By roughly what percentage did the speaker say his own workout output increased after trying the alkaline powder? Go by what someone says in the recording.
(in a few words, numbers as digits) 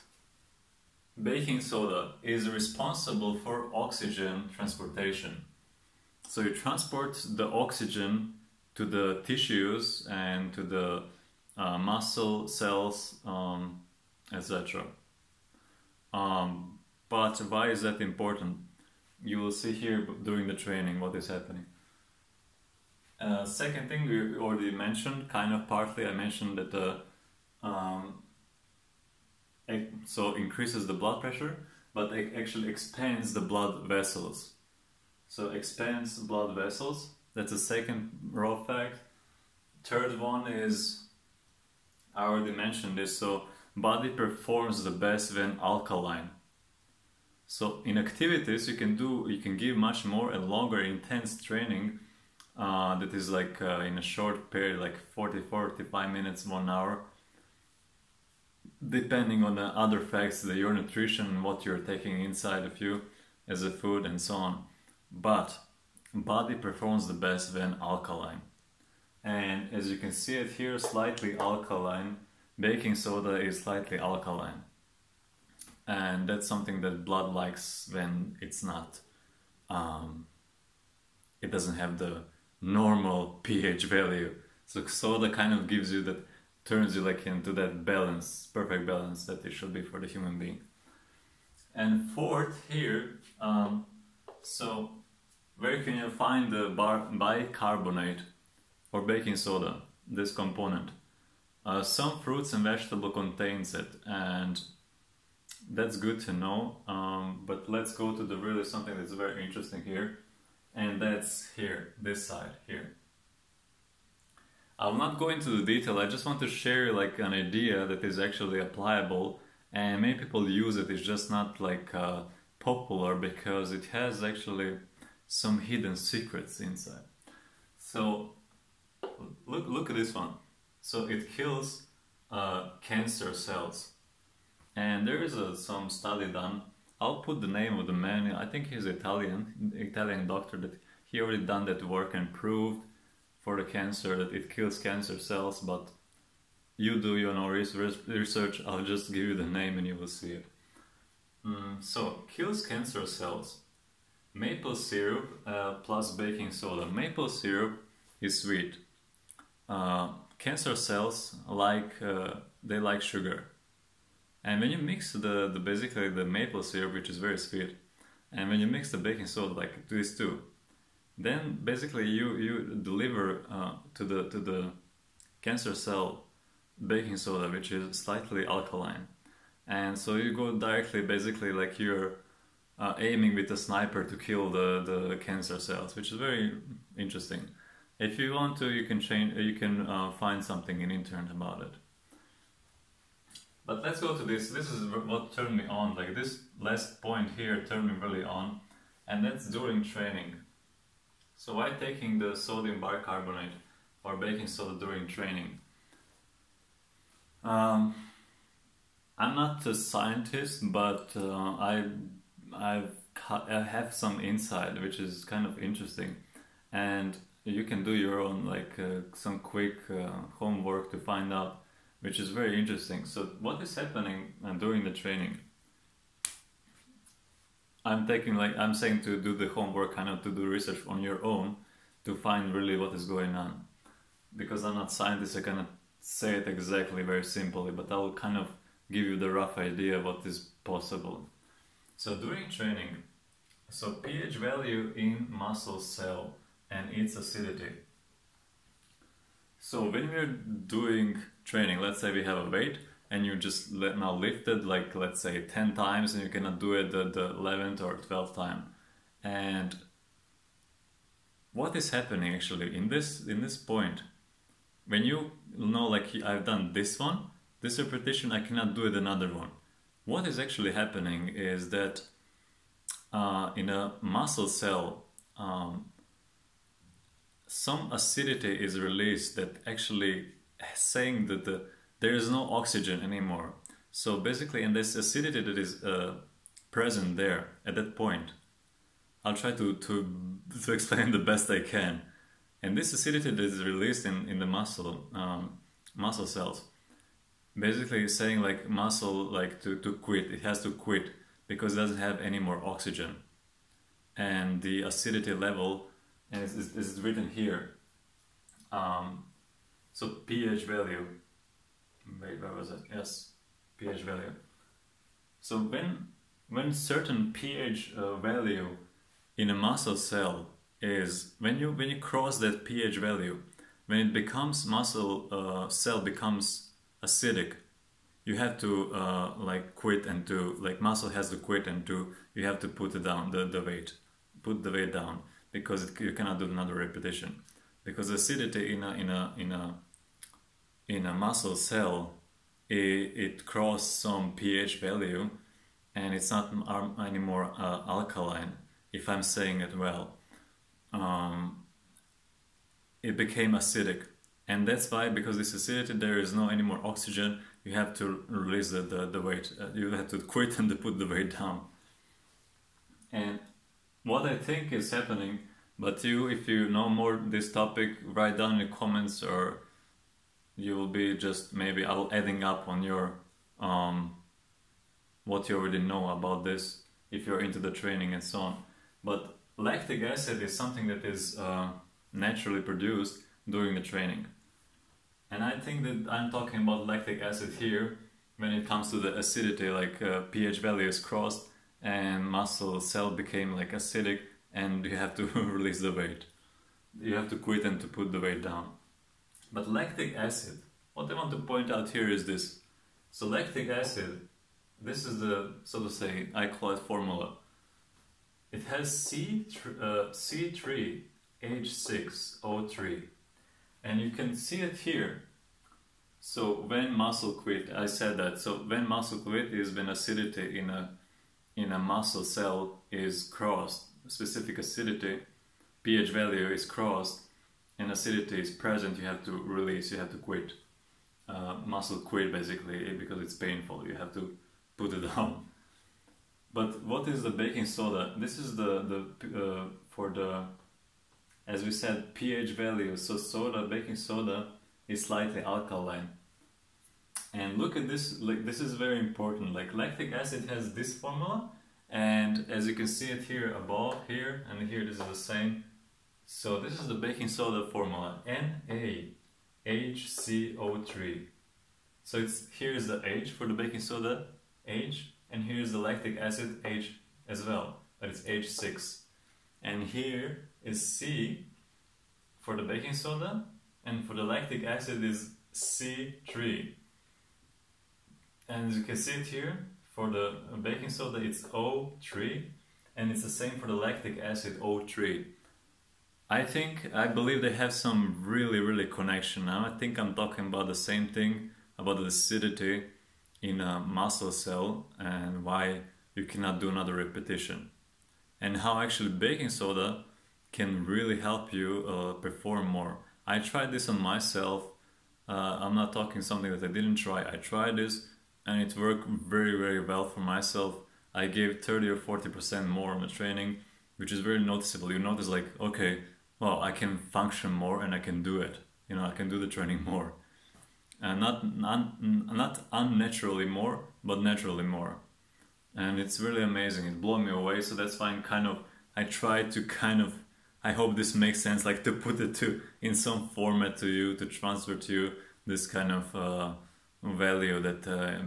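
30 or 40 percent.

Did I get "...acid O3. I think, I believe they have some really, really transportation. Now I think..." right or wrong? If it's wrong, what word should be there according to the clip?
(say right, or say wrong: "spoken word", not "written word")
wrong: "connection", not "transportation".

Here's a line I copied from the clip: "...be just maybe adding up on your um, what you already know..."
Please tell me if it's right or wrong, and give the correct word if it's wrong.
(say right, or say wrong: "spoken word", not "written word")
right.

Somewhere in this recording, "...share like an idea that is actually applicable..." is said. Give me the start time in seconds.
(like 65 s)
116 s.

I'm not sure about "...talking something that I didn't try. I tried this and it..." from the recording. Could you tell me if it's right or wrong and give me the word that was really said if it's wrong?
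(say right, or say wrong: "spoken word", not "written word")
right.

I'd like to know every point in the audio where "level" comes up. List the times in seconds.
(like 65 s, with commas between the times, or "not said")
305 s.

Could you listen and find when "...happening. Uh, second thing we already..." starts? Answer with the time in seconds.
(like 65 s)
21 s.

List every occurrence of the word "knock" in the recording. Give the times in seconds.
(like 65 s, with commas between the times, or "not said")
not said.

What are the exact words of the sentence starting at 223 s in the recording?
So, what is happening during the training?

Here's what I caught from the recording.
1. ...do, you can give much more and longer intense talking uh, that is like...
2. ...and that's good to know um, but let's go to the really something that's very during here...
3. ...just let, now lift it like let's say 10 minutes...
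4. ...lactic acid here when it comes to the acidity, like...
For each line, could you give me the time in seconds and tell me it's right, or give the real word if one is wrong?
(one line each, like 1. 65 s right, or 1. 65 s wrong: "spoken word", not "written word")
1. 48 s wrong: "training", not "talking"
2. 104 s wrong: "interesting", not "during"
3. 253 s wrong: "times", not "minutes"
4. 386 s right.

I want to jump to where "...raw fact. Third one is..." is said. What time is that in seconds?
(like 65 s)
38 s.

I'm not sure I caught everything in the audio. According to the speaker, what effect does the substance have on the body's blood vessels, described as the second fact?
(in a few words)
expands blood vessels.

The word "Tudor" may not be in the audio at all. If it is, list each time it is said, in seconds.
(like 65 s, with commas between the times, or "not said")
not said.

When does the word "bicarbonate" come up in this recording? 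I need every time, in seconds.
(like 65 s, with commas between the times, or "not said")
96 s, 202 s.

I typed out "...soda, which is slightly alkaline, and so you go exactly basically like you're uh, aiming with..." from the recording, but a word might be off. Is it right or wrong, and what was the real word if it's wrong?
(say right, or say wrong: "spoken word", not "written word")
wrong: "directly", not "exactly".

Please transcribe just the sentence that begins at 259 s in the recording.
And what is happening actually in this in this point?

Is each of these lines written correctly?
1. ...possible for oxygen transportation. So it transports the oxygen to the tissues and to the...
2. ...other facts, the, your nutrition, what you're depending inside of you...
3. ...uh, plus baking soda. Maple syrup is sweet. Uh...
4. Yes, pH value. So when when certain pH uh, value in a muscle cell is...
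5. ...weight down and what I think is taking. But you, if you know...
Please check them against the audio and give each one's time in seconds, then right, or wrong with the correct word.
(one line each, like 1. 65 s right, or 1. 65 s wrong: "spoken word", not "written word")
1. 2 s wrong: "responsible", not "possible"
2. 59 s wrong: "taking", not "depending"
3. 155 s right
4. 312 s right
5. 361 s wrong: "happening", not "taking".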